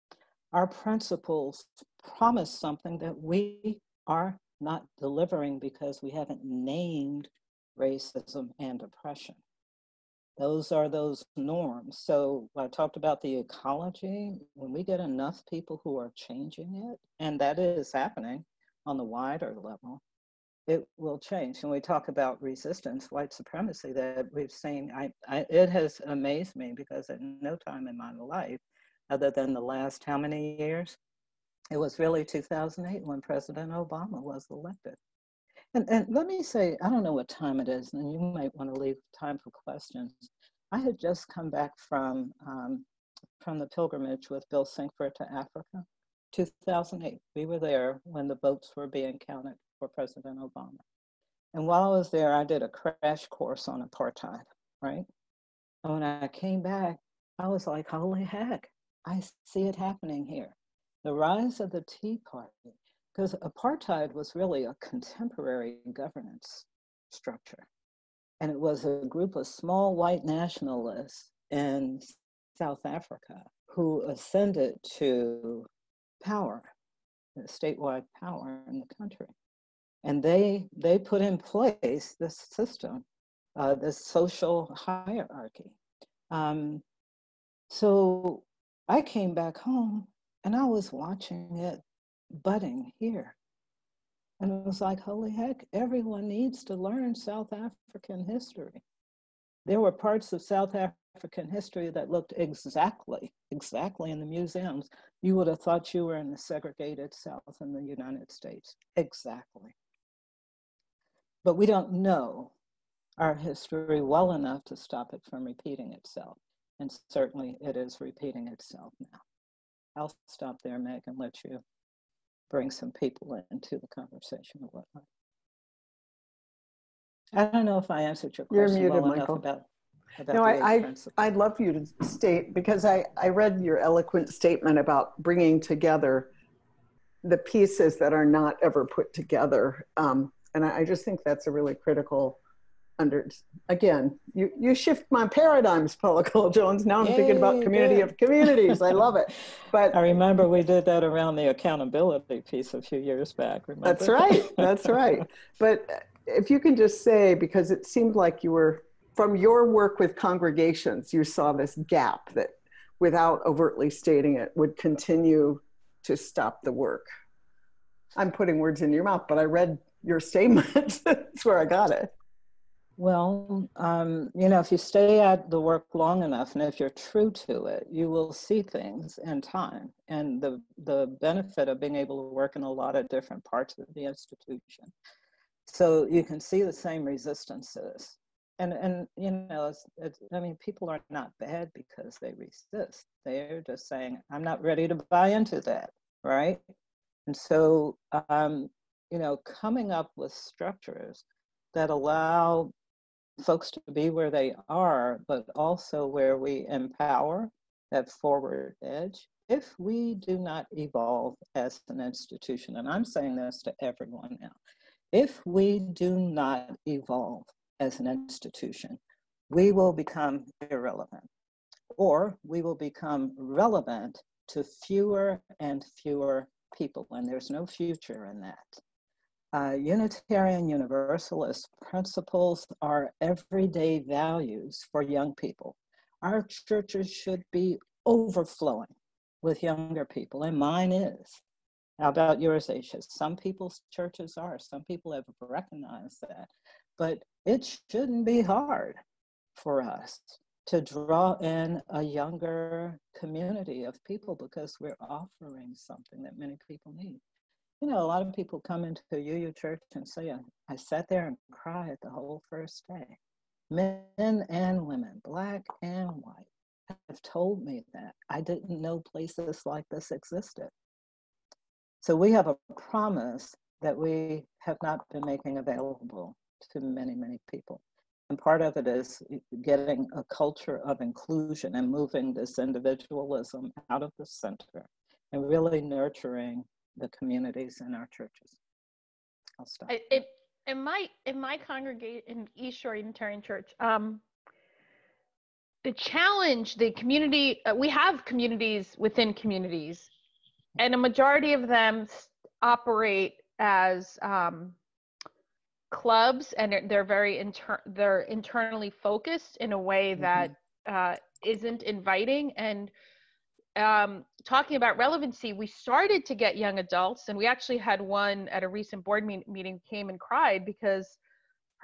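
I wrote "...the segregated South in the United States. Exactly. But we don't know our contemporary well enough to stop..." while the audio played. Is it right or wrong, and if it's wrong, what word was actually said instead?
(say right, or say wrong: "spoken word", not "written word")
wrong: "history", not "contemporary".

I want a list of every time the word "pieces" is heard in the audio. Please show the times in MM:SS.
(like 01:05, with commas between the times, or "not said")
02:17, 02:32.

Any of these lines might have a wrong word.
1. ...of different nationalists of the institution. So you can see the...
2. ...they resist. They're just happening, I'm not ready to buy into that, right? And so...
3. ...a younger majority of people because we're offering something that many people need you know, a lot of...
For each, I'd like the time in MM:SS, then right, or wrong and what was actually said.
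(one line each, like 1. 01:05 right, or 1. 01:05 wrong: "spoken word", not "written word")
1. 03:02 wrong: "parts", not "nationalists"
2. 03:12 wrong: "saying", not "happening"
3. 04:11 wrong: "community", not "majority".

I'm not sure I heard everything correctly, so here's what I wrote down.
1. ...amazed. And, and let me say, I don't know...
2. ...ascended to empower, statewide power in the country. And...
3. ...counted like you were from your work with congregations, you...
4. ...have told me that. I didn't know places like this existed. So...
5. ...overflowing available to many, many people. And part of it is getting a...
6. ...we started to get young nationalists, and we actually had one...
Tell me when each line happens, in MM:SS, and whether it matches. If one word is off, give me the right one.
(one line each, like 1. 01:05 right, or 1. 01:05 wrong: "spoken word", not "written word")
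1. 00:34 wrong: "elected", not "amazed"
2. 01:14 wrong: "power", not "empower"
3. 02:37 wrong: "seemed", not "counted"
4. 04:27 right
5. 04:35 wrong: "making", not "overflowing"
6. 05:15 wrong: "adults", not "nationalists".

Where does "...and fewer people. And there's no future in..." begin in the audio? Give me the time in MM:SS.
03:45.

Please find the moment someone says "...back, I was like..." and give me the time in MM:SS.
00:56.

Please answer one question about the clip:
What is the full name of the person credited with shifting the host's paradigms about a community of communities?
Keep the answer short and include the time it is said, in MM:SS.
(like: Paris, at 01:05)
Paula Cole Jones, at 02:25.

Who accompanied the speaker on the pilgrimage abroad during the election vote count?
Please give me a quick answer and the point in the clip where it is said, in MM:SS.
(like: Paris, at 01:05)
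Bill Sinkford, at 00:44.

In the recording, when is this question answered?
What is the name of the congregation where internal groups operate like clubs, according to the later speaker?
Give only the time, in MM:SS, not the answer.
04:52.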